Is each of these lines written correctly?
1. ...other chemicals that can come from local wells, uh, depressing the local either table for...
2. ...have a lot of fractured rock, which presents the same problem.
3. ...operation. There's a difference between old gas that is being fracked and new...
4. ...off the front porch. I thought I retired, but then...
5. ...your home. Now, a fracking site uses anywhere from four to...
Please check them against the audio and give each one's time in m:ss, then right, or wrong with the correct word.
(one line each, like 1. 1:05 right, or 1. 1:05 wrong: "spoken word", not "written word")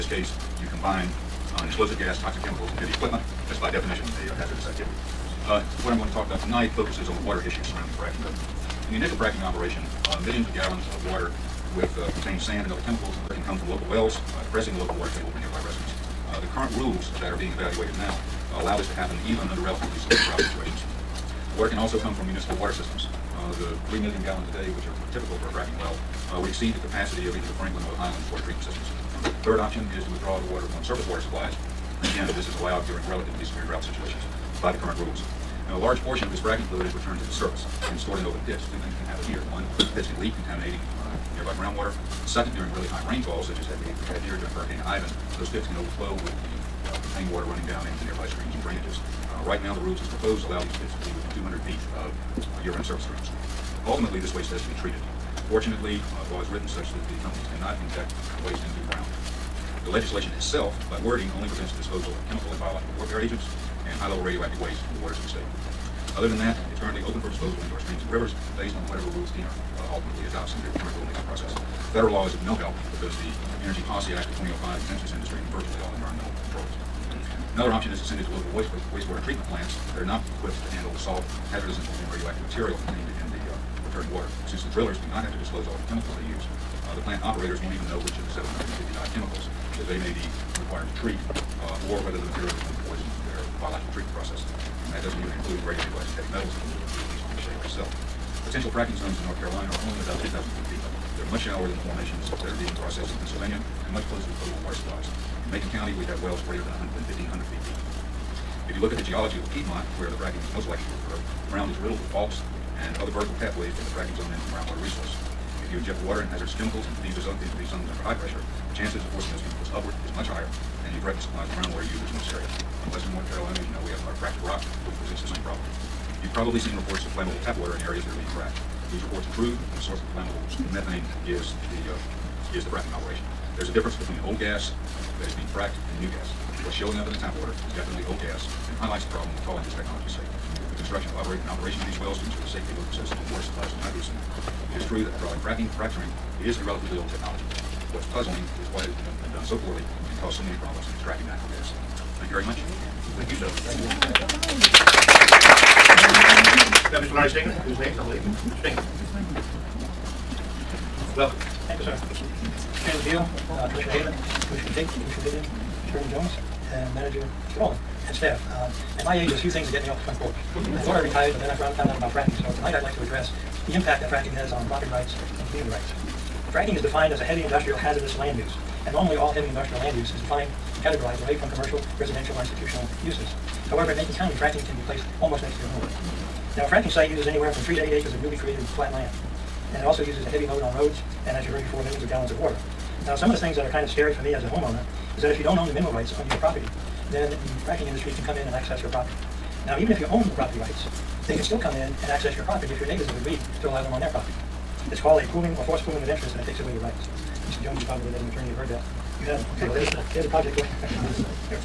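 1. 0:12 wrong: "water", not "either"
2. 2:03 right
3. 2:12 right
4. 2:49 right
5. 3:05 wrong: "three", not "four".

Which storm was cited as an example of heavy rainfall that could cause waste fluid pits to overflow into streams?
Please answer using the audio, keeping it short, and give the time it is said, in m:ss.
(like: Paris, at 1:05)
Hurricane Ivan, at 0:44.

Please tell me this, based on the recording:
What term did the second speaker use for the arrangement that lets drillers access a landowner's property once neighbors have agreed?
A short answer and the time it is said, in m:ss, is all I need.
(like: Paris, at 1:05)
forced pooling, at 3:25.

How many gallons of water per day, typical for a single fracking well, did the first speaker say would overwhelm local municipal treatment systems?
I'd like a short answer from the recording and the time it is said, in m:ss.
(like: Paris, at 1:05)
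3 million, at 0:23.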